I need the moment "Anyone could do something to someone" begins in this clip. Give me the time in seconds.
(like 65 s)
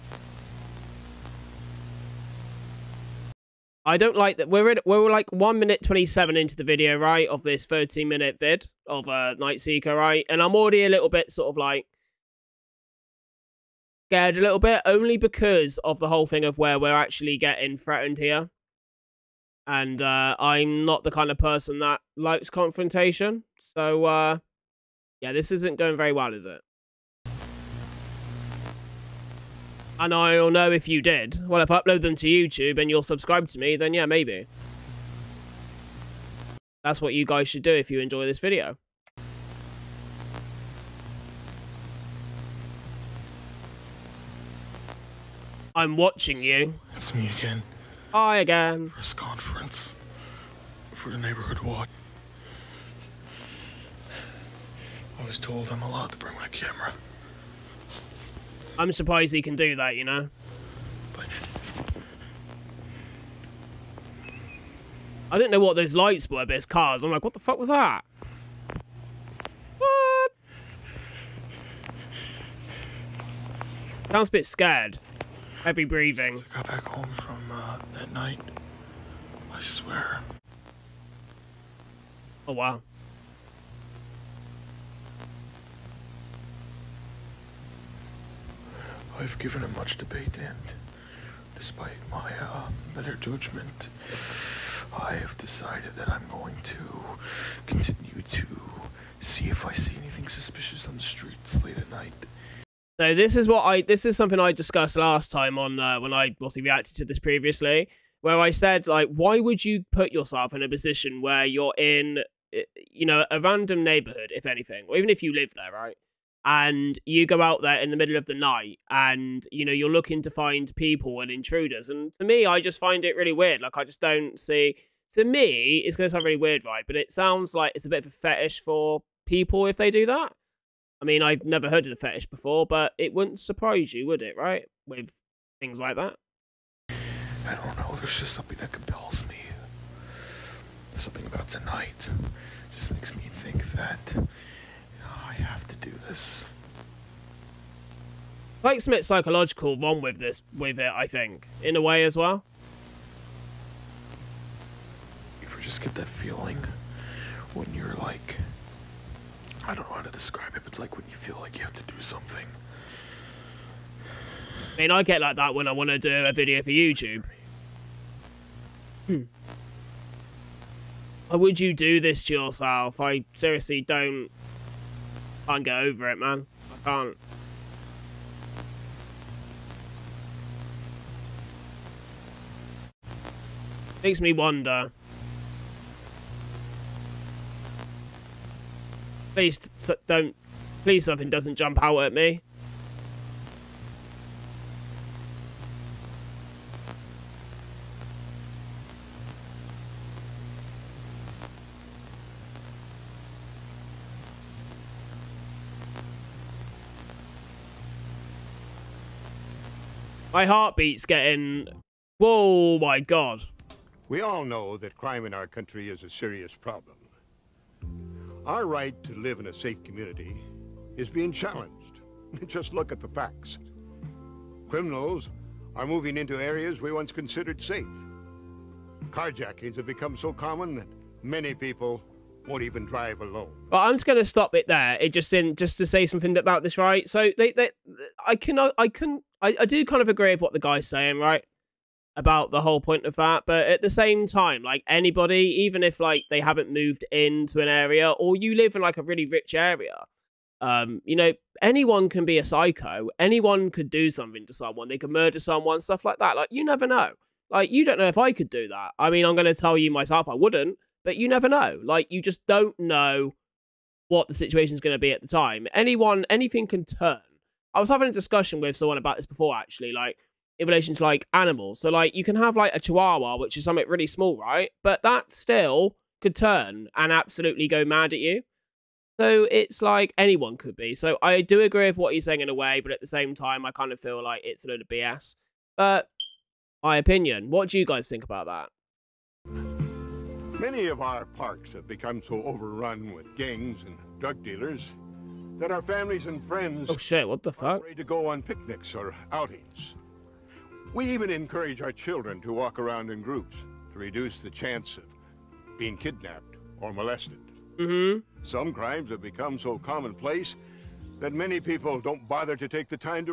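253 s.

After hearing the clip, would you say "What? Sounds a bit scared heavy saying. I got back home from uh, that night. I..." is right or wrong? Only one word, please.
wrong.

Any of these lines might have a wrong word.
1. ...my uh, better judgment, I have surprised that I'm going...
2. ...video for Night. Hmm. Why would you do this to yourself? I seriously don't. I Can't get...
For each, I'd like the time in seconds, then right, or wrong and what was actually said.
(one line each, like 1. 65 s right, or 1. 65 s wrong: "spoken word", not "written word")
1. 92 s wrong: "decided", not "surprised"
2. 166 s wrong: "YouTube", not "Night".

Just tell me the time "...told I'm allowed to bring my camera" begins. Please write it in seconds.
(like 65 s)
55 s.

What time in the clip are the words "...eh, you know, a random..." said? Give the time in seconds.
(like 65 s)
112 s.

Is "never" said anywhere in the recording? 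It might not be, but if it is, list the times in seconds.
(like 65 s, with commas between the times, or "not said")
131 s, 256 s, 261 s.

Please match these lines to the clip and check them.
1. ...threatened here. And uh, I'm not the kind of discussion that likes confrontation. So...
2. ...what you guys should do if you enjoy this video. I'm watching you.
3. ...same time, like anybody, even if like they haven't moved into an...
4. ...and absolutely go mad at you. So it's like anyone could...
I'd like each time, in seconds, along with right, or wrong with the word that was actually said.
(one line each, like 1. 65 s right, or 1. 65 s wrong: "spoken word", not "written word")
1. 17 s wrong: "person", not "discussion"
2. 37 s right
3. 243 s right
4. 276 s right.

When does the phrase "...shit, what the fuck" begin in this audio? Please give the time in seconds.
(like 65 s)
296 s.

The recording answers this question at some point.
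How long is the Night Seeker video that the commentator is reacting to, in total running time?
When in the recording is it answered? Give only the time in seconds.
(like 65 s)
7 s.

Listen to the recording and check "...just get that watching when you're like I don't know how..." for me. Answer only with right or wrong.
wrong.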